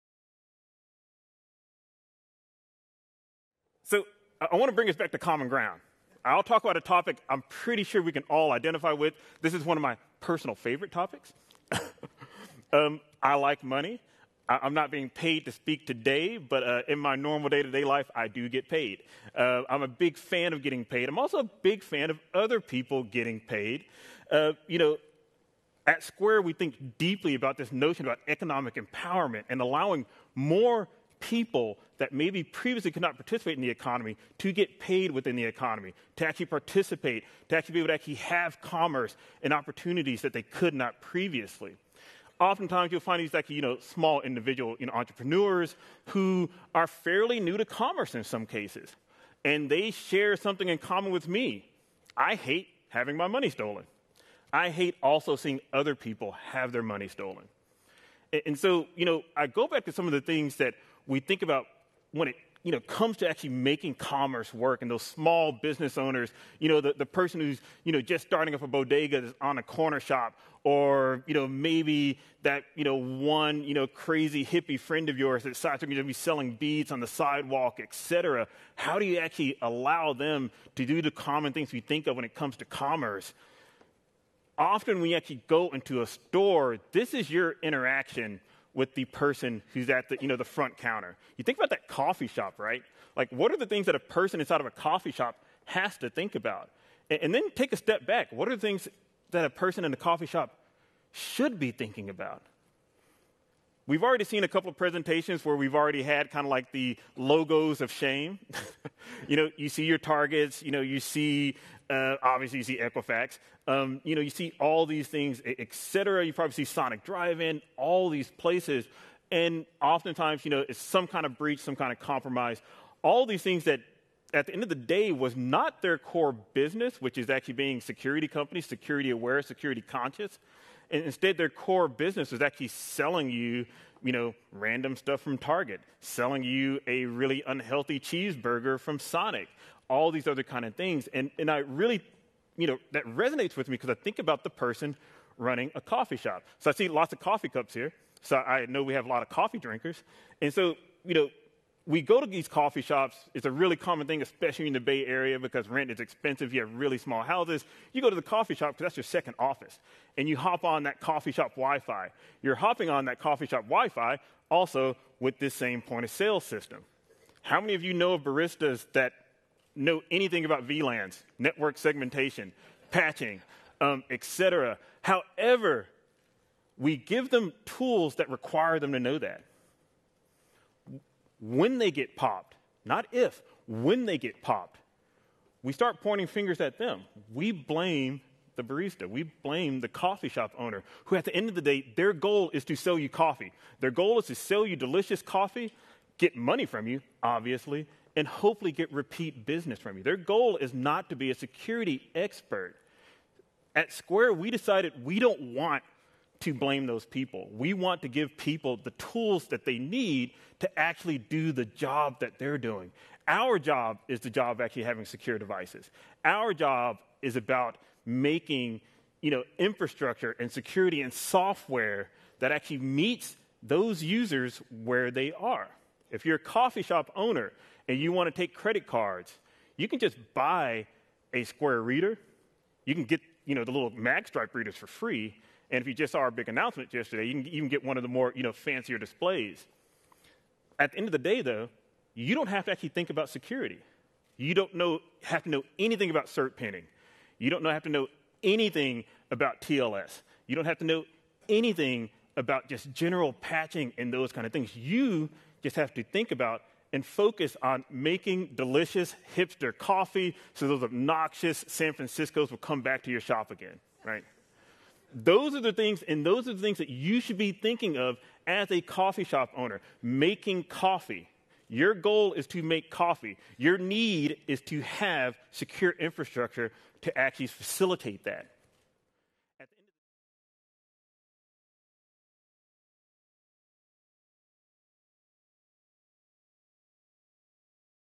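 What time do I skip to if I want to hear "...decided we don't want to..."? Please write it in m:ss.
3:24.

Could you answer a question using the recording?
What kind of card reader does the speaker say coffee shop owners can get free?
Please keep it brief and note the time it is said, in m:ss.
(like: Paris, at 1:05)
MagStripe readers, at 3:53.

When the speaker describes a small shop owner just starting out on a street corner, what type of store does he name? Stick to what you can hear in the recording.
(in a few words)
bodega.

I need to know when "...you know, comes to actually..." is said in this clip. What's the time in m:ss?
1:02.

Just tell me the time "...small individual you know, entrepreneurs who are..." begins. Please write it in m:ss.
0:43.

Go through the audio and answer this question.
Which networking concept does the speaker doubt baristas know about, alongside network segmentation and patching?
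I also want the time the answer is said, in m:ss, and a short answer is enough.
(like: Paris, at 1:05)
VLANs, at 2:50.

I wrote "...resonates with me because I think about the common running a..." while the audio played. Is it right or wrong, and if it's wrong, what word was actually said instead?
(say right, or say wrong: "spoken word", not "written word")
wrong: "person", not "common".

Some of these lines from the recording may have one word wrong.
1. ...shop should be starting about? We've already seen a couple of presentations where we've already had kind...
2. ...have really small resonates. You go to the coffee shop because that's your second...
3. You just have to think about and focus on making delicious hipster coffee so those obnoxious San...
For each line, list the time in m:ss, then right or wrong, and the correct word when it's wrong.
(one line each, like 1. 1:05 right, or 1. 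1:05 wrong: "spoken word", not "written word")
1. 1:40 wrong: "thinking", not "starting"
2. 2:36 wrong: "houses", not "resonates"
3. 4:14 right.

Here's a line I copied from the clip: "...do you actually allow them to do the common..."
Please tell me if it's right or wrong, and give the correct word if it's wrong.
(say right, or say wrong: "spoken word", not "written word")
right.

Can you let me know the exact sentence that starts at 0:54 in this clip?
I hate also seeing other people have their money stolen.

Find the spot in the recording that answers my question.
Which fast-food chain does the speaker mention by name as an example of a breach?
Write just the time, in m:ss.
1:56.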